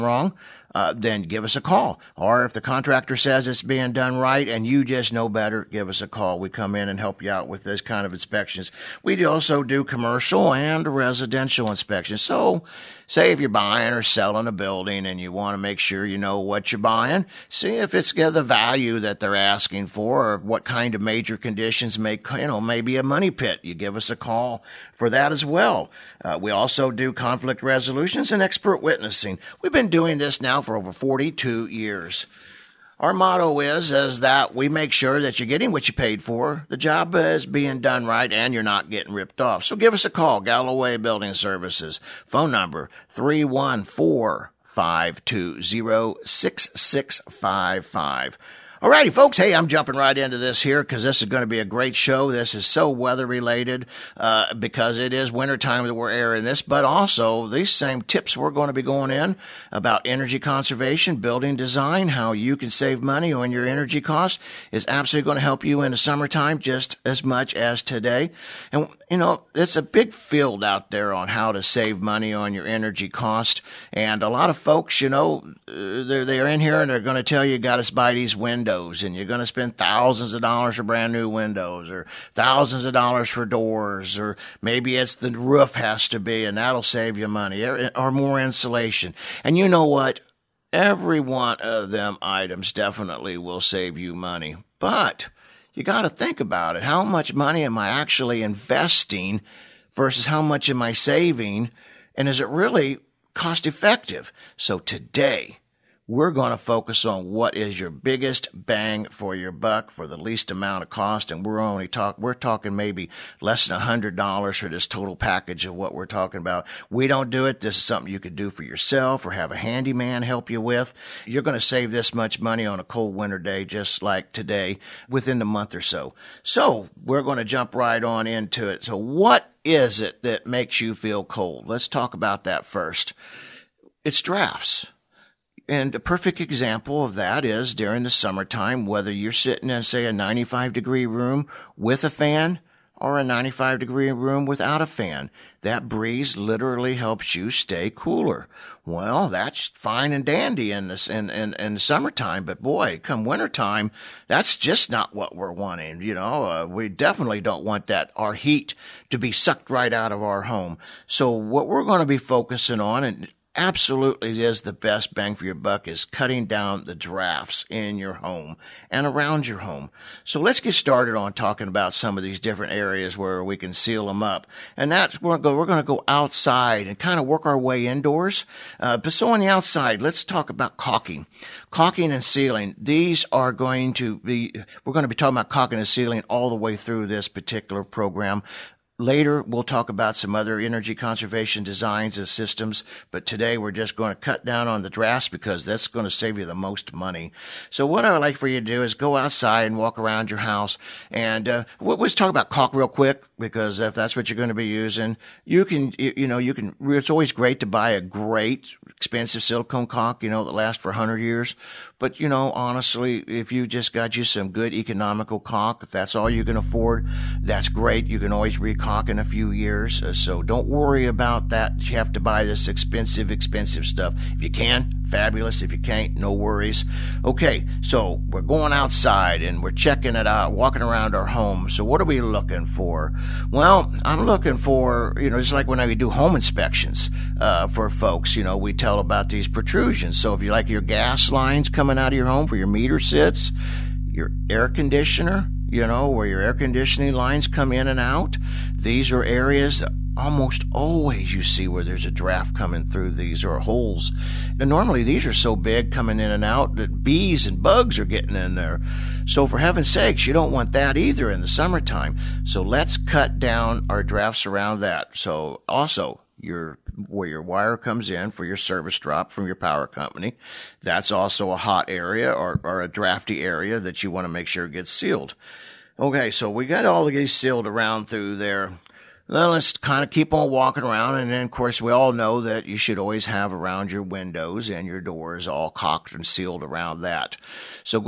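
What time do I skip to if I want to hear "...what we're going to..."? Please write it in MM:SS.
02:41.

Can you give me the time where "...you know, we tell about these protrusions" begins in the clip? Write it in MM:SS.
03:58.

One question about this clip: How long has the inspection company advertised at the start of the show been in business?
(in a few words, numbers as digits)
over 42 years.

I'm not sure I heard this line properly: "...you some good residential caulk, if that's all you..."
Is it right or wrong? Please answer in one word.
wrong.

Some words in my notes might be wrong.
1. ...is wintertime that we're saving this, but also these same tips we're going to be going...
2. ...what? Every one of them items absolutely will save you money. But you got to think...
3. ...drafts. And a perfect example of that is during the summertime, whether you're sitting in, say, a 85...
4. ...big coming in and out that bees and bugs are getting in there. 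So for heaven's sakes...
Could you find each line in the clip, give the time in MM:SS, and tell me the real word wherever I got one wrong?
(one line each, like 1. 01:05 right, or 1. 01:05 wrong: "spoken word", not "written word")
1. 00:55 wrong: "airing", not "saving"
2. 01:29 wrong: "definitely", not "absolutely"
3. 02:14 wrong: "95", not "85"
4. 04:15 right.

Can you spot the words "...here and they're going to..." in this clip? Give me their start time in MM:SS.
01:16.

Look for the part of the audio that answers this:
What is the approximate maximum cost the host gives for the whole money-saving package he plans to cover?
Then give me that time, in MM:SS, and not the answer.
01:53.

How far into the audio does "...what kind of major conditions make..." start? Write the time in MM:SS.
00:20.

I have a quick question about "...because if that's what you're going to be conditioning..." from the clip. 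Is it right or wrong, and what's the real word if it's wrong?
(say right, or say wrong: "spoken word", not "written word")
wrong: "using", not "conditioning".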